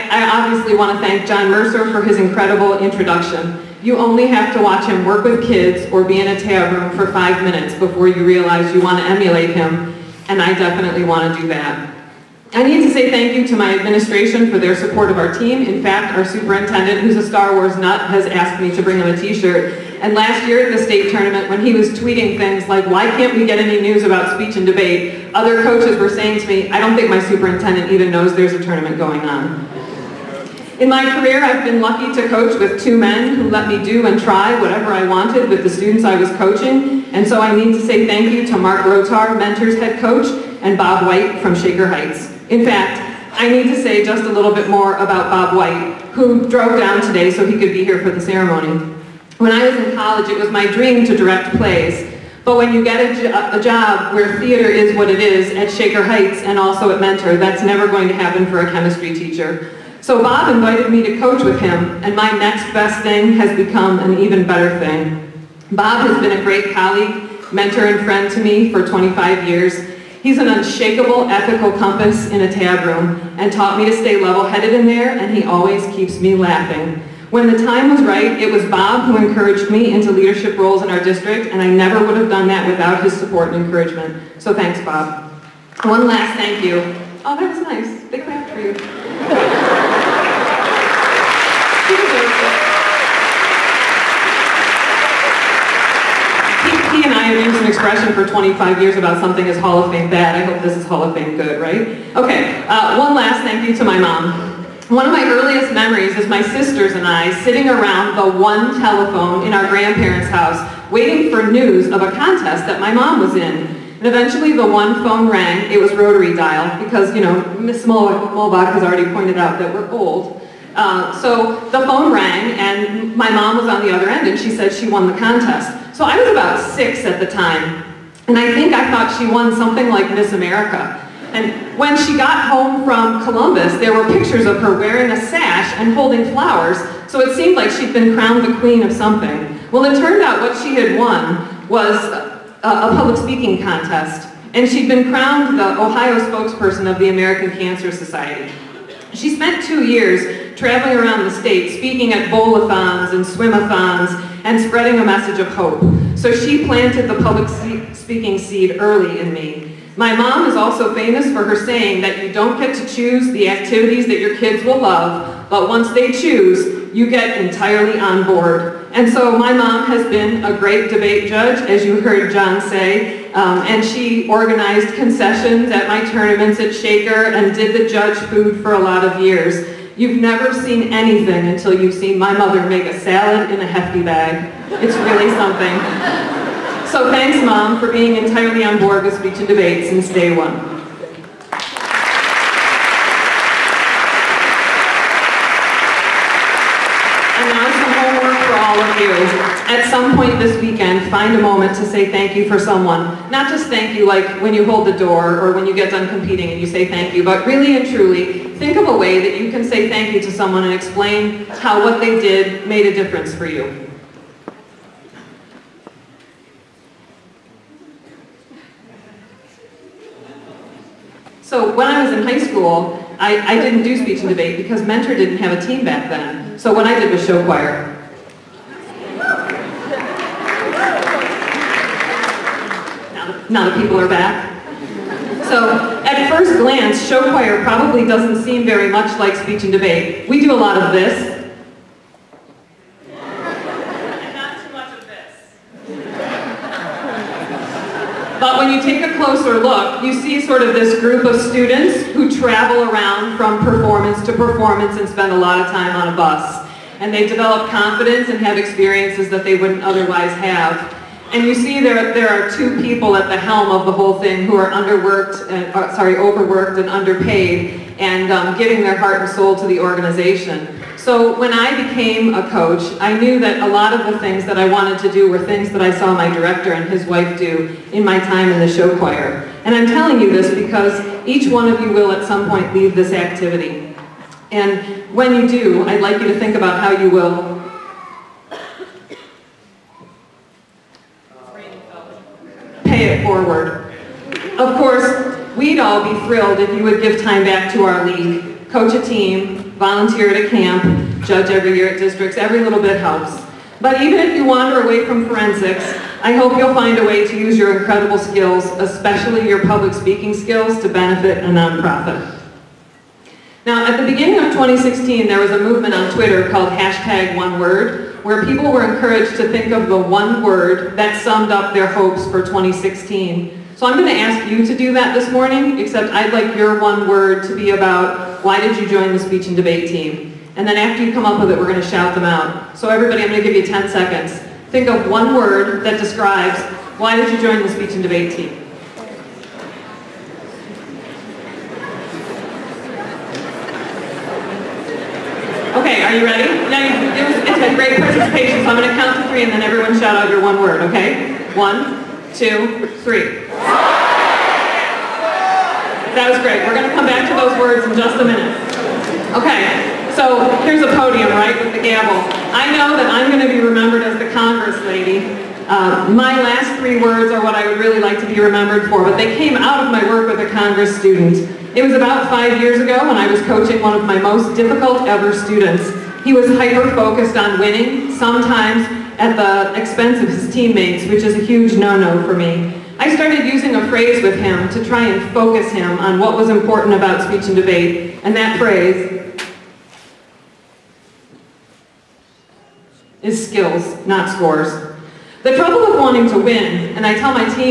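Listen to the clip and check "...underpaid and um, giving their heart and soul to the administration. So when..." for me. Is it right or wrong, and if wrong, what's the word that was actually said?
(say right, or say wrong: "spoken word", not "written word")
wrong: "organization", not "administration".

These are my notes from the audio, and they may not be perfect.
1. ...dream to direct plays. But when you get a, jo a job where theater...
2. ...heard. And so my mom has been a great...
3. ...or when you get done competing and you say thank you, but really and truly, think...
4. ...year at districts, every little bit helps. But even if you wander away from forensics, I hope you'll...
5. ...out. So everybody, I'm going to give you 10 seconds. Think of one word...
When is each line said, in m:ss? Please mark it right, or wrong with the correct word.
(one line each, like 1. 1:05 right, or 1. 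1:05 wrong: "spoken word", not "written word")
1. 0:50 right
2. 2:48 wrong: "board", not "heard"
3. 3:25 right
4. 5:01 right
5. 5:32 right.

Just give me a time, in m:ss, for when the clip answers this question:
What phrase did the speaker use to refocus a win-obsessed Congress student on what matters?
6:33.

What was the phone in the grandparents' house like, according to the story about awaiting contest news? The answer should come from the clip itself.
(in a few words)
rotary dial.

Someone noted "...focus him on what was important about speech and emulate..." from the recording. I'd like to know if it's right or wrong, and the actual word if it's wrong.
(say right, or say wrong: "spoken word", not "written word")
wrong: "debate", not "emulate".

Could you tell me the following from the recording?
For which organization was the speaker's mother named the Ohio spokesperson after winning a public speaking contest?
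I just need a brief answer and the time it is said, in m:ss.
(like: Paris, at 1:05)
American Cancer Society, at 2:27.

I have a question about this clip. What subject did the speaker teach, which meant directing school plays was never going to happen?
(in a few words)
chemistry.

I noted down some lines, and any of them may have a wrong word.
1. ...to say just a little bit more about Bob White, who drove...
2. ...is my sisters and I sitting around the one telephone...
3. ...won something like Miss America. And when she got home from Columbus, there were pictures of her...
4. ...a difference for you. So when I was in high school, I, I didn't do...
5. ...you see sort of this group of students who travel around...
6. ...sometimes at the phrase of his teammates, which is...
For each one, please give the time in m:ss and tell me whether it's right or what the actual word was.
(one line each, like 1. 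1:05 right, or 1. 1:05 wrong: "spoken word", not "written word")
1. 0:43 right
2. 1:46 right
3. 2:09 right
4. 3:32 right
5. 4:10 right
6. 6:18 wrong: "expense", not "phrase".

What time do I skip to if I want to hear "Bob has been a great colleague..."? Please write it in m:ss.
1:05.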